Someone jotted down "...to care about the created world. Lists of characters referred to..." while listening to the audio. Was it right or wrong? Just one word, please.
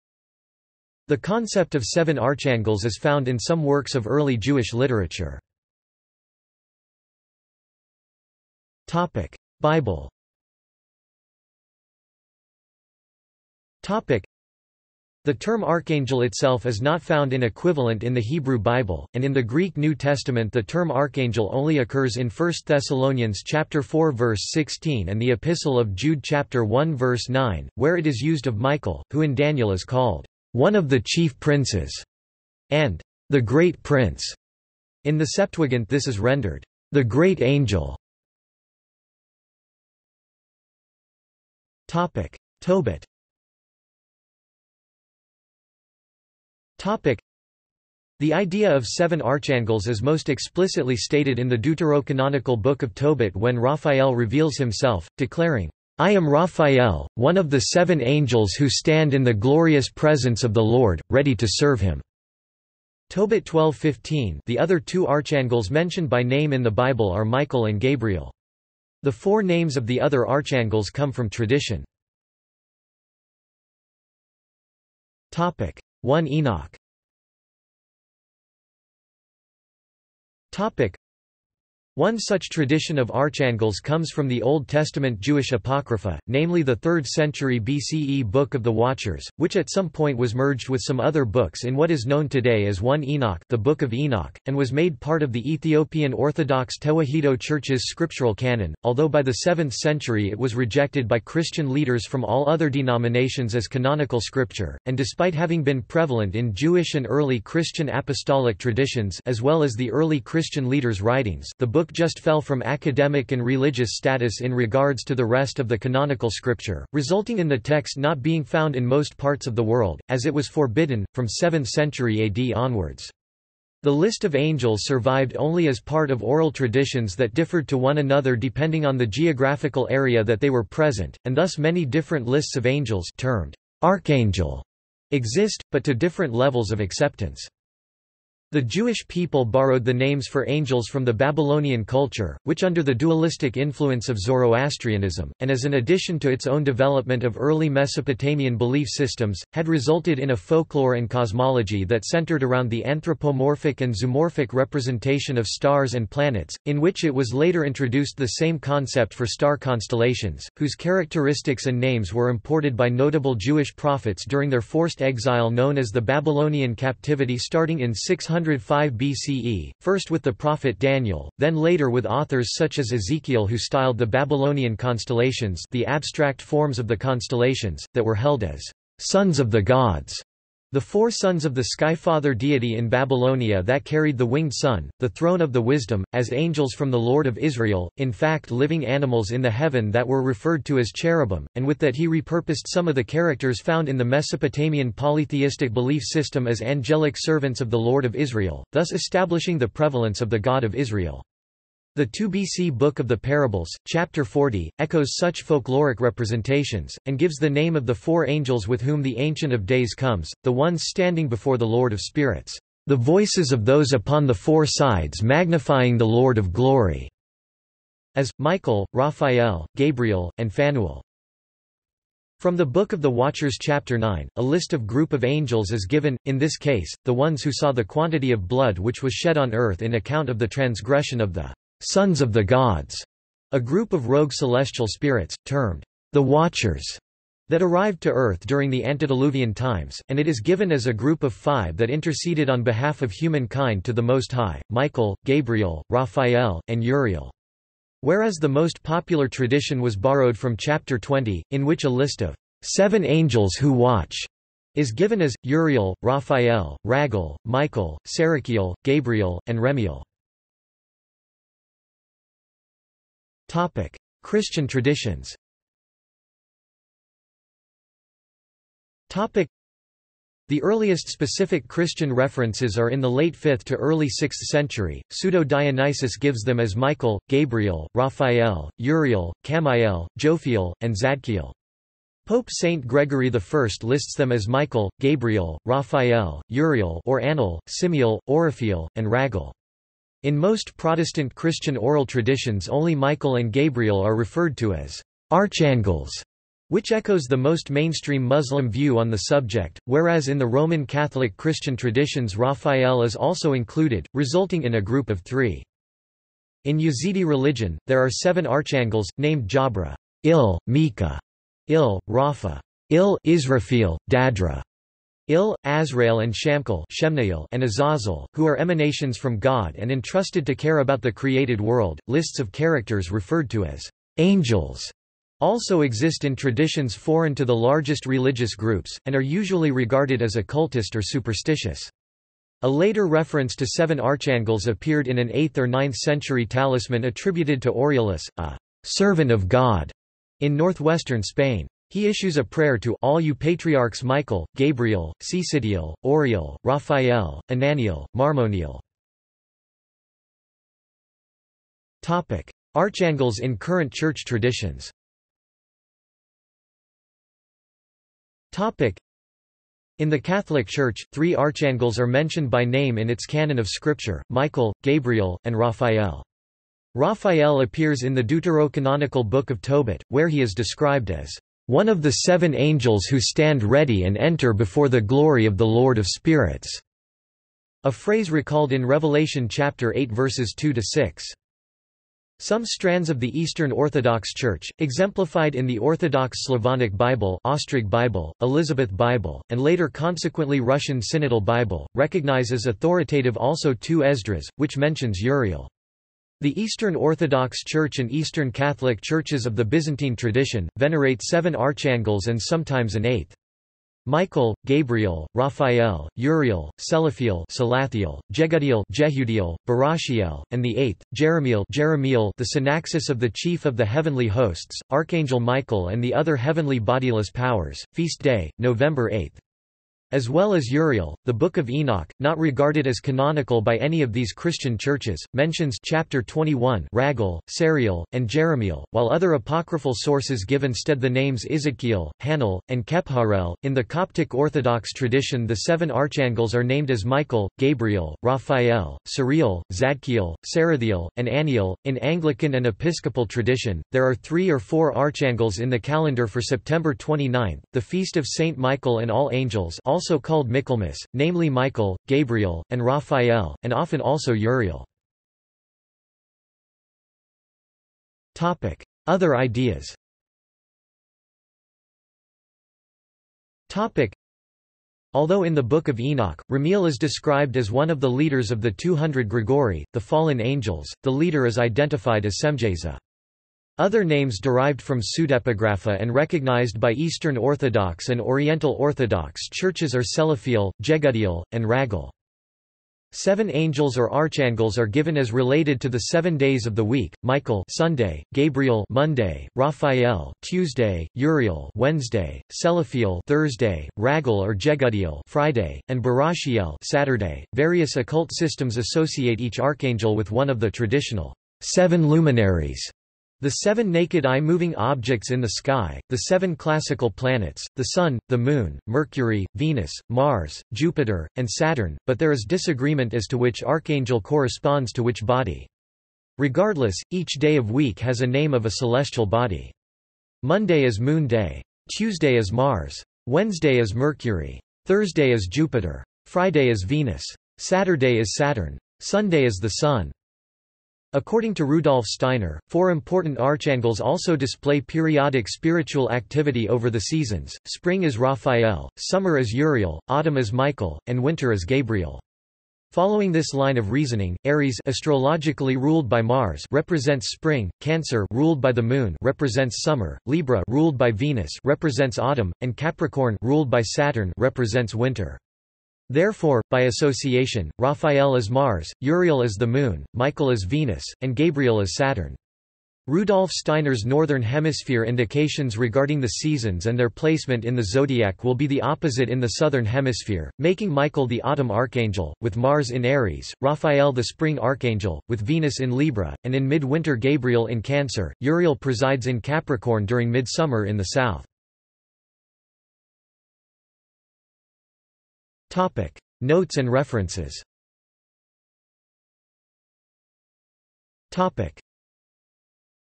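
right.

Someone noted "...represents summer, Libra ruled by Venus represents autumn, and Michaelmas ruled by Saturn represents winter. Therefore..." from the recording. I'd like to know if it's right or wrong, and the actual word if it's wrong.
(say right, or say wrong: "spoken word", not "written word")
wrong: "Capricorn", not "Michaelmas".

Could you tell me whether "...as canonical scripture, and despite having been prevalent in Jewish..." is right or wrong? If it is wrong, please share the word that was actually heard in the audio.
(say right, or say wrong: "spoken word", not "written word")
right.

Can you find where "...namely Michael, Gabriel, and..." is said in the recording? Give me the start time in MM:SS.
07:31.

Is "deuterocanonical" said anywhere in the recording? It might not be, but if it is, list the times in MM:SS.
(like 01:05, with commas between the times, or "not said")
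00:51, 06:08.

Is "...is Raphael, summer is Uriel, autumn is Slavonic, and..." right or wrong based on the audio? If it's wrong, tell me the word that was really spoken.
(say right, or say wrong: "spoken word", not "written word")
wrong: "Michael", not "Slavonic".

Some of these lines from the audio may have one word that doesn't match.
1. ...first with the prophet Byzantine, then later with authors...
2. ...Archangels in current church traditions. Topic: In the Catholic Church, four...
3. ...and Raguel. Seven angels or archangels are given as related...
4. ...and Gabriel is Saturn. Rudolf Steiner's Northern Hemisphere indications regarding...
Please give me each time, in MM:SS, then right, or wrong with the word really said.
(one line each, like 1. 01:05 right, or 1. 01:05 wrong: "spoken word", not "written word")
1. 02:49 wrong: "Daniel", not "Byzantine"
2. 05:52 wrong: "three", not "four"
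3. 08:01 right
4. 09:21 right.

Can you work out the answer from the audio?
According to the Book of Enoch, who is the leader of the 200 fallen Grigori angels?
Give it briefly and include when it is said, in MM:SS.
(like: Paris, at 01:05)
Semjaza, at 07:52.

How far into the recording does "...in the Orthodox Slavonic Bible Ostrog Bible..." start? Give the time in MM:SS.
06:25.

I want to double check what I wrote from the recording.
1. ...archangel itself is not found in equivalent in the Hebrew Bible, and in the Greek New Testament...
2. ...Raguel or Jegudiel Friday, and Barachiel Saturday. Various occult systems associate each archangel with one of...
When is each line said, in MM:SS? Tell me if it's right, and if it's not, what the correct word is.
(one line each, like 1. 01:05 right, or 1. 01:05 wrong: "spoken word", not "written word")
1. 00:15 right
2. 08:13 right.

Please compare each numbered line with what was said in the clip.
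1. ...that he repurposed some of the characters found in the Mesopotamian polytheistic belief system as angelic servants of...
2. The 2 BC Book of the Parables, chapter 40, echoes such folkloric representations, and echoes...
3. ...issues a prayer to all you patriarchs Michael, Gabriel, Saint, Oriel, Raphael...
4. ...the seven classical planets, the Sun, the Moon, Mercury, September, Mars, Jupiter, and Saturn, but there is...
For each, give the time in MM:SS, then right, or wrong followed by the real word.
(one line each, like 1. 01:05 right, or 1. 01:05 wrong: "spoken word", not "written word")
1. 03:11 right
2. 03:21 wrong: "gives", not "echoes"
3. 05:42 wrong: "Cecidiel", not "Saint"
4. 08:26 wrong: "Venus", not "September".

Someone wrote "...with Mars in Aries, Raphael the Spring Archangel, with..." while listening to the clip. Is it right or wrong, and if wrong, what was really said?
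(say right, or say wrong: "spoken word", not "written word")
right.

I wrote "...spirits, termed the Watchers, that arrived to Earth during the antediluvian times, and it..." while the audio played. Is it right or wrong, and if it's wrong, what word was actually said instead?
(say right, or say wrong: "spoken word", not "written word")
right.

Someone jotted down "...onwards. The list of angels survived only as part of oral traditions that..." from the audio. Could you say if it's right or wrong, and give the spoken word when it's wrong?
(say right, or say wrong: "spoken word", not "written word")
right.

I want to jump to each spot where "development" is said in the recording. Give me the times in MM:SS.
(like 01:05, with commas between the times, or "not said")
02:26.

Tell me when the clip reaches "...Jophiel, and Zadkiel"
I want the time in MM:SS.
04:40.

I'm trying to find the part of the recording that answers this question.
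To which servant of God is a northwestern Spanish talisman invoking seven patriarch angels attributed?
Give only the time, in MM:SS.
05:37.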